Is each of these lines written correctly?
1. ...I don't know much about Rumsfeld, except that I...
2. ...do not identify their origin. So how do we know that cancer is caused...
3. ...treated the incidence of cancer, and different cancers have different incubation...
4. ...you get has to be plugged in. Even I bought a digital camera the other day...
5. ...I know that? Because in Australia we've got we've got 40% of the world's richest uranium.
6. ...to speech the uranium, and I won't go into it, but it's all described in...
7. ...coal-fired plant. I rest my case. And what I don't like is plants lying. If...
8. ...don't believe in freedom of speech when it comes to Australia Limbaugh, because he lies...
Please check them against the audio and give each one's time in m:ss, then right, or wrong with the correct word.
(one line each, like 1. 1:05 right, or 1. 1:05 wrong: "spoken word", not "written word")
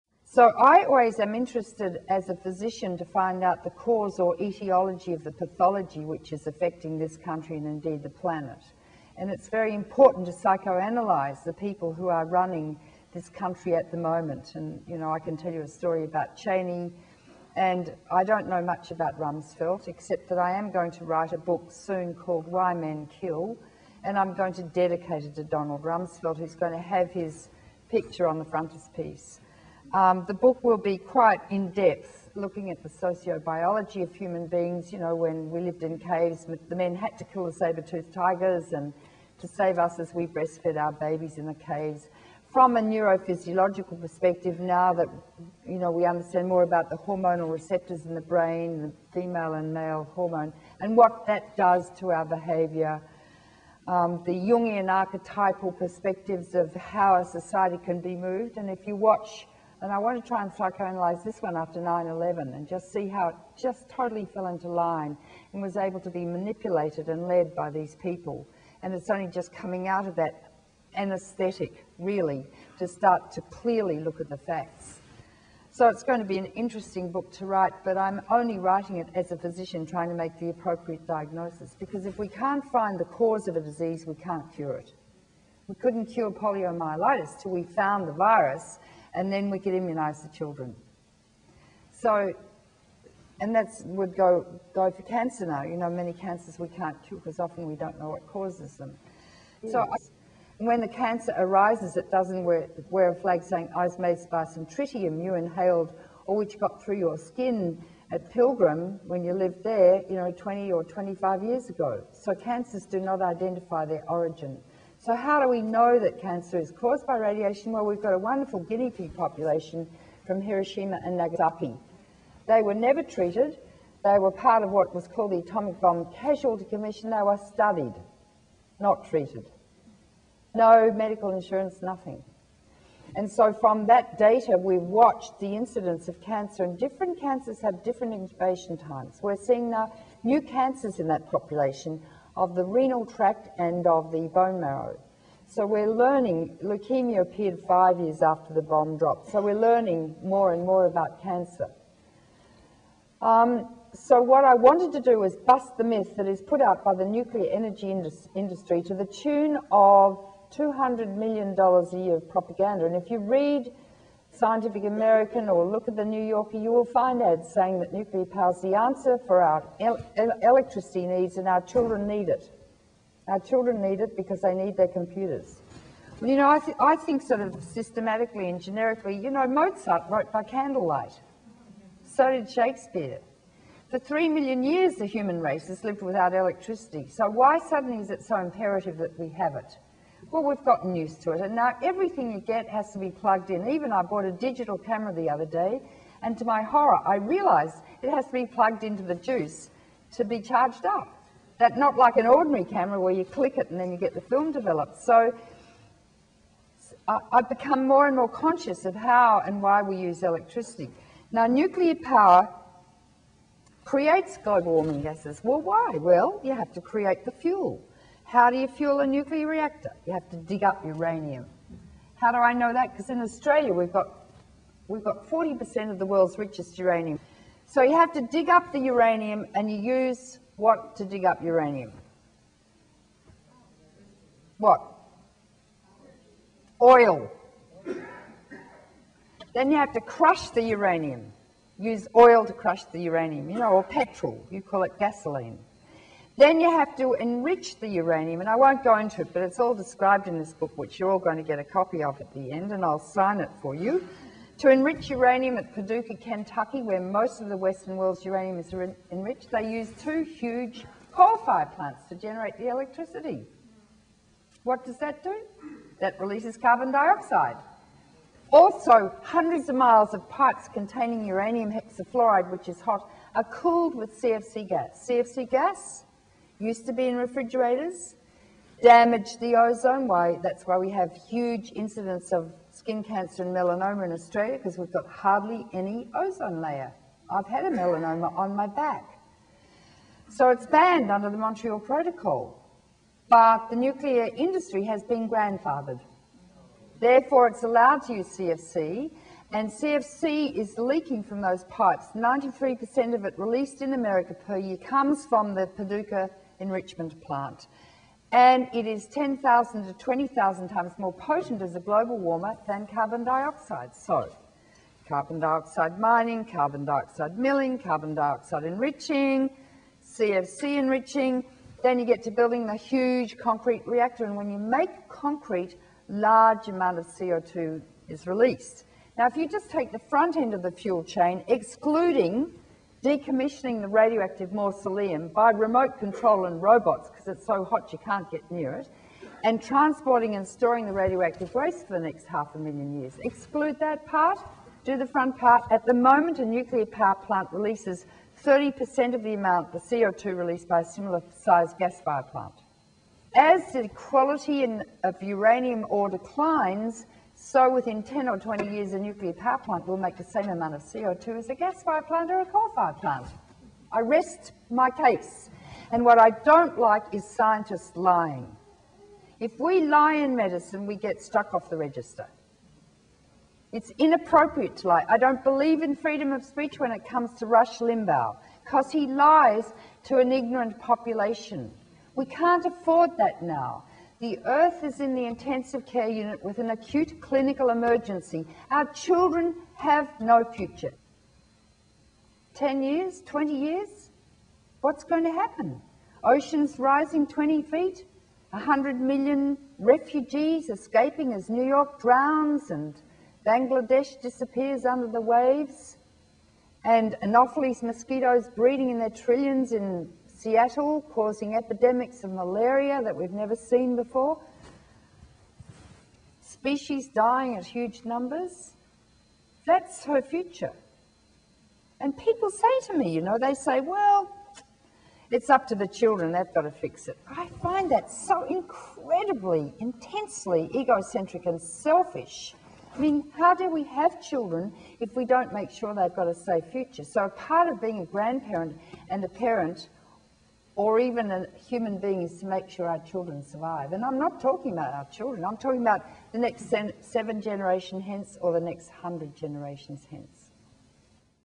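1. 0:18 right
2. 1:52 right
3. 2:14 wrong: "watched", not "treated"
4. 3:12 right
5. 3:42 right
6. 4:06 wrong: "enrich", not "speech"
7. 6:02 wrong: "scientists", not "plants"
8. 6:15 wrong: "Rush", not "Australia".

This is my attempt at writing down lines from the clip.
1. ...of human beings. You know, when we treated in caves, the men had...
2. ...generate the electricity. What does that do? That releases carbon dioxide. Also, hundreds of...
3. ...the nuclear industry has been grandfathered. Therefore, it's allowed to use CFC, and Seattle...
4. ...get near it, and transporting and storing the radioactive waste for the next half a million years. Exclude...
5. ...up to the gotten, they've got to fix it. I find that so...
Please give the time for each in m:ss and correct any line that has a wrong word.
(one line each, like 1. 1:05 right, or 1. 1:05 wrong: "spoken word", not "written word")
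1. 0:34 wrong: "lived", not "treated"
2. 4:22 right
3. 4:53 wrong: "CFC", not "Seattle"
4. 5:38 right
5. 7:05 wrong: "children", not "gotten".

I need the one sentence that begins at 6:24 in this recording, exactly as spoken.
The earth is in the intensive care unit with an acute clinical emergency.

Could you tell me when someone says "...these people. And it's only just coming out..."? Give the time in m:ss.
1:07.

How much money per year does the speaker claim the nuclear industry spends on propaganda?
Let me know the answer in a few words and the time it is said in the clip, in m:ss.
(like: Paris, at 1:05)
$200 million, at 2:40.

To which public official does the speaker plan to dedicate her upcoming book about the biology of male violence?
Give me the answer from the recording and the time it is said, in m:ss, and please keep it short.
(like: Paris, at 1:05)
Donald Rumsfeld, at 0:25.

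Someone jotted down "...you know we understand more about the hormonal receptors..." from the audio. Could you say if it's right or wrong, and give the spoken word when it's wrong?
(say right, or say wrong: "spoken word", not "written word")
right.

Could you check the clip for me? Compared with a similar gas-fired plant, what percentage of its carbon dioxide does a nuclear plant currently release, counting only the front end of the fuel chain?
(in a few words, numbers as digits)
30%.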